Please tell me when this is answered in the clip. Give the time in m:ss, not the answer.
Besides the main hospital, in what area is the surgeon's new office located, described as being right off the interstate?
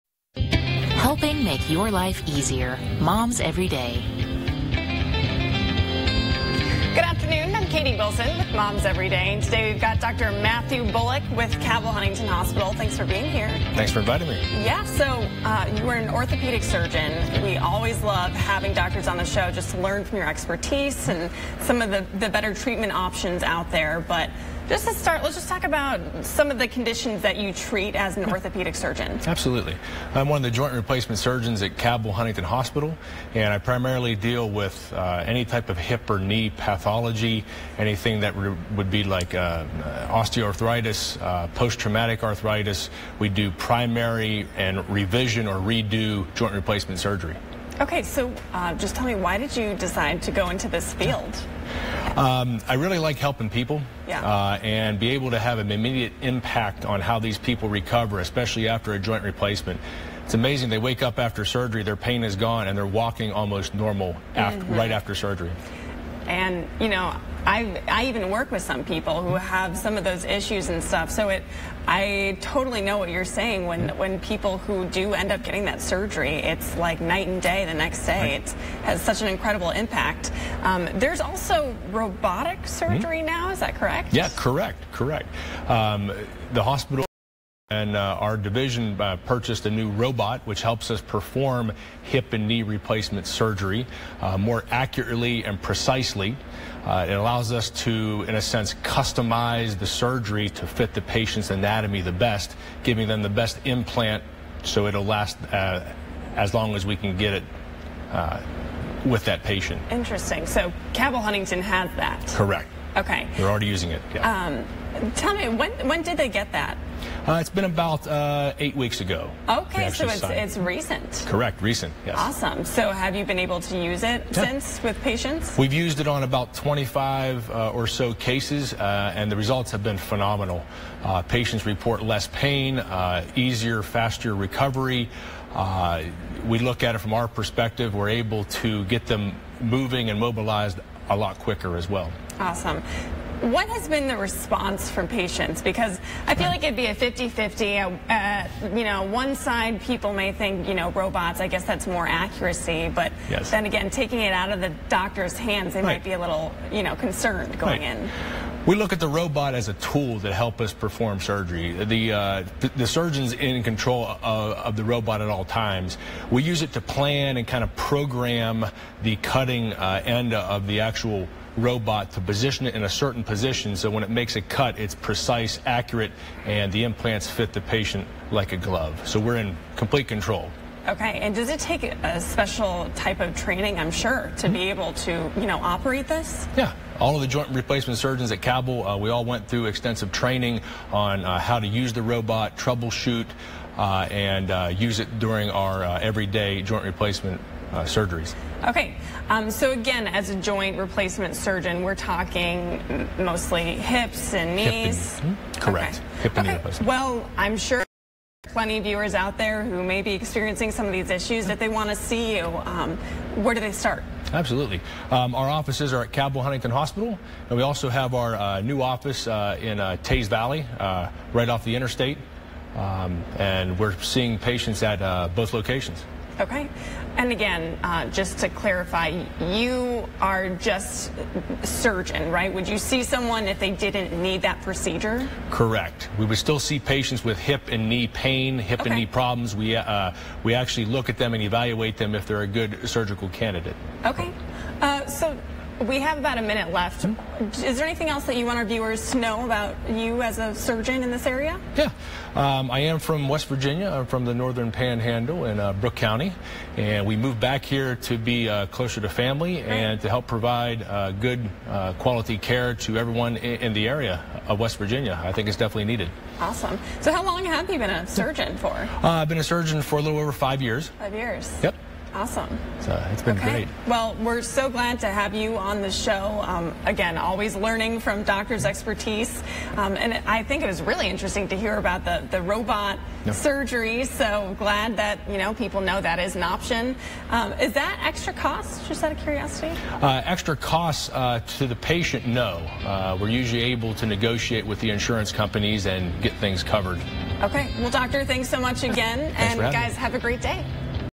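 3:40.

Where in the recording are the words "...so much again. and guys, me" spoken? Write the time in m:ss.
4:58.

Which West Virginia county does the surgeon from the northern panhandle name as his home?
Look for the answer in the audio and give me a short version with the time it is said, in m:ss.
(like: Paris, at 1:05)
Brooke County, at 4:15.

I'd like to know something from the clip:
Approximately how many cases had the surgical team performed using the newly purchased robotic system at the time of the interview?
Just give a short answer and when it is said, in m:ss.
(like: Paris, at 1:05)
25, at 2:06.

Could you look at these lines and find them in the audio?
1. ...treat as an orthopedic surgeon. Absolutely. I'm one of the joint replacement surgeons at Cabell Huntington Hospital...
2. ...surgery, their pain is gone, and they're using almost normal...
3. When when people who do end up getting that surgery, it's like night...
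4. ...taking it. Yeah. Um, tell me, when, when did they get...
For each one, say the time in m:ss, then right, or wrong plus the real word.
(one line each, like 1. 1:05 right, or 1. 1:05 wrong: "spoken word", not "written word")
1. 0:27 right
2. 1:01 wrong: "walking", not "using"
3. 1:13 right
4. 1:53 wrong: "using", not "taking".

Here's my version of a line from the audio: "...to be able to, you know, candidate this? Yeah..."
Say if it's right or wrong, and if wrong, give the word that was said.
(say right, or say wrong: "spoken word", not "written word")
wrong: "operate", not "candidate".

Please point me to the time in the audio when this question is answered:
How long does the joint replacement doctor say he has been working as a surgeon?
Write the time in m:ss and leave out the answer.
4:29.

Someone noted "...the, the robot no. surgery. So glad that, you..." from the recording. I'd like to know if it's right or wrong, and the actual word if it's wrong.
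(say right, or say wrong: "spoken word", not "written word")
right.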